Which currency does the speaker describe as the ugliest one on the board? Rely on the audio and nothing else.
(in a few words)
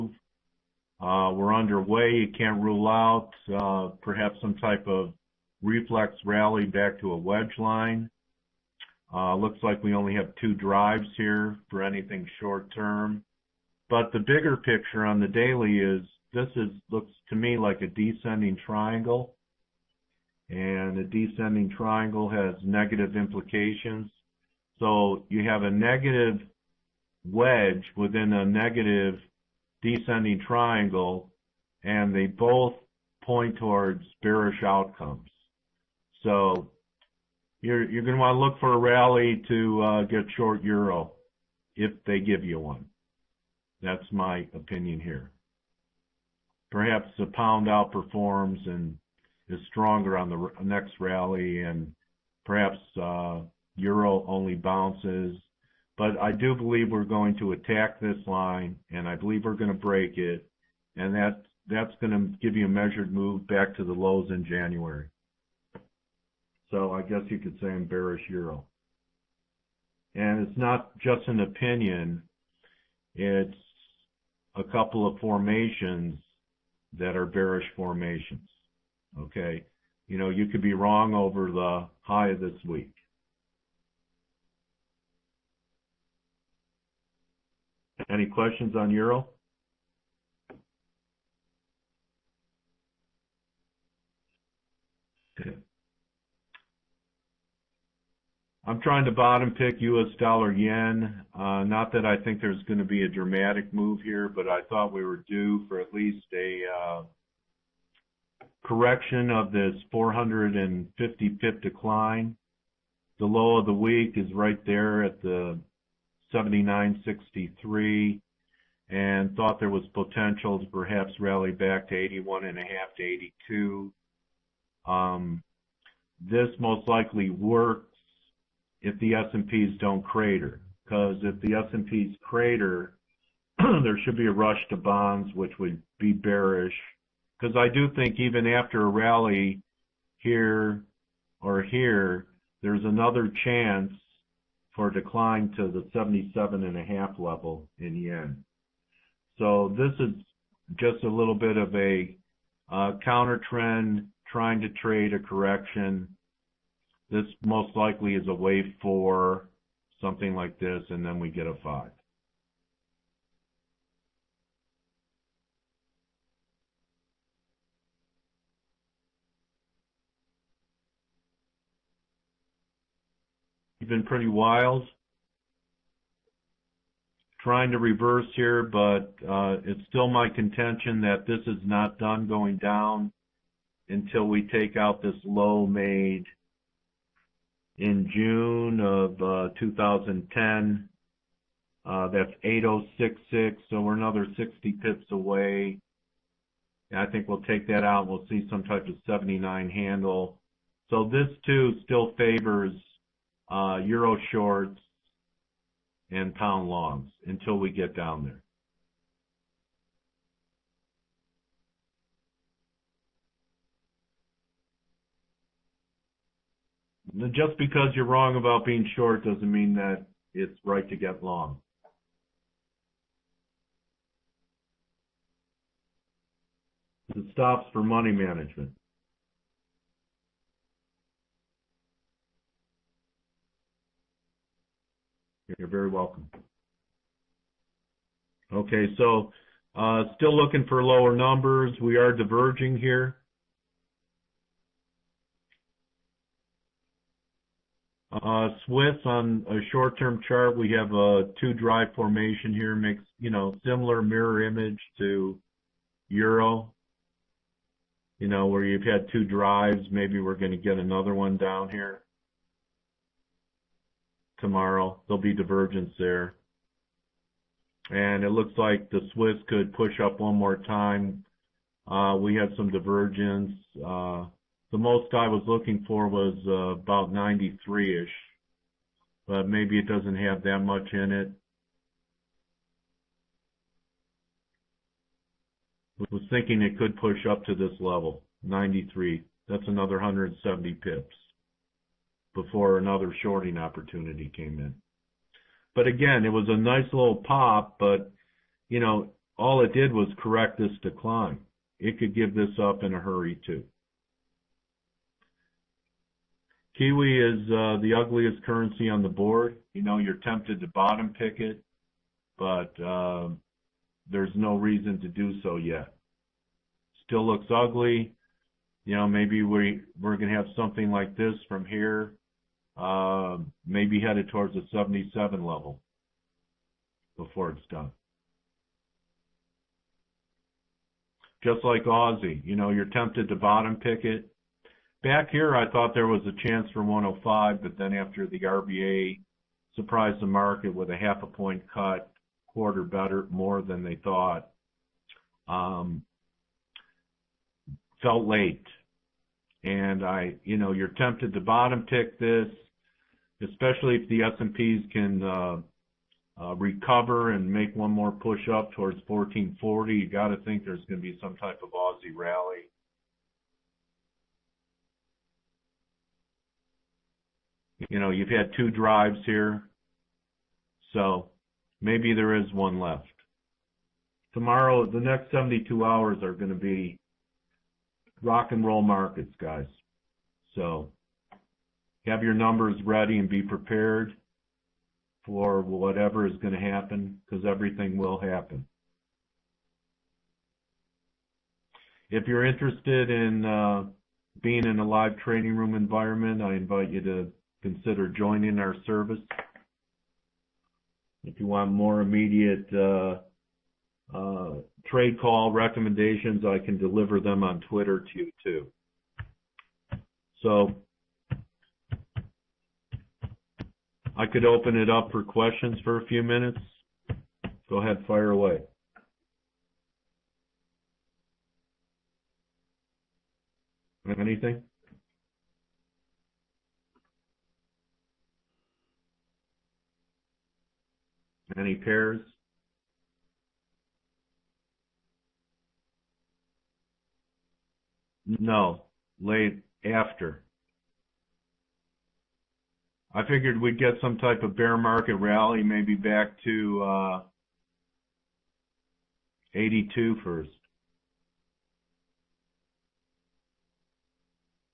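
Kiwi.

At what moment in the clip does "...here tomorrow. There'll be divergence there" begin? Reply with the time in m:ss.
4:21.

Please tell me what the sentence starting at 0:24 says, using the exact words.
So You have a negative wedge within a negative descending triangle, and they both point towards bearish outcomes.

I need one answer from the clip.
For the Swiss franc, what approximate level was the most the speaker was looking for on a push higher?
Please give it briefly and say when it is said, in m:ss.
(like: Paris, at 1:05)
93, at 4:37.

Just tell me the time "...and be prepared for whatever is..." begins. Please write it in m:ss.
6:23.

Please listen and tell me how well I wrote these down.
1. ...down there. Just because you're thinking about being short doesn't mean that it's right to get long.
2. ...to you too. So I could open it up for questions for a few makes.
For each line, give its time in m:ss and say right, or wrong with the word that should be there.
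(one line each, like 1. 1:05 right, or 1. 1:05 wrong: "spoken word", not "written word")
1. 3:27 wrong: "wrong", not "thinking"
2. 6:47 wrong: "minutes", not "makes".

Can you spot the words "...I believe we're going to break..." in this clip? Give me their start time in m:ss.
0:59.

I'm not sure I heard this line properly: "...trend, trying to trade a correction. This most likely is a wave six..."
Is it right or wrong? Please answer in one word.
wrong.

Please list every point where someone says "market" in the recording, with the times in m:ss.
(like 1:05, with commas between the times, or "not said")
5:40, 6:18, 7:24.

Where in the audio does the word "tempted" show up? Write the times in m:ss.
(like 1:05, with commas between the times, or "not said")
5:10, 5:32, 5:50.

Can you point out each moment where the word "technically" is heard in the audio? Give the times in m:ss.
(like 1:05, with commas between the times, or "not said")
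not said.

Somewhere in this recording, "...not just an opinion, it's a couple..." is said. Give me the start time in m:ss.
1:10.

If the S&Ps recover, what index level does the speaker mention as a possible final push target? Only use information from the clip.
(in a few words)
1,440.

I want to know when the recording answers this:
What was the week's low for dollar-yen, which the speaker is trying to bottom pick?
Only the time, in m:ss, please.
1:56.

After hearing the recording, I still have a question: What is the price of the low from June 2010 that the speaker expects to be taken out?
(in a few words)
8066.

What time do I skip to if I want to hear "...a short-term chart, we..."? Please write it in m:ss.
4:09.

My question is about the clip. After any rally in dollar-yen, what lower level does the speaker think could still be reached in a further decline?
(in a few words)
77.5.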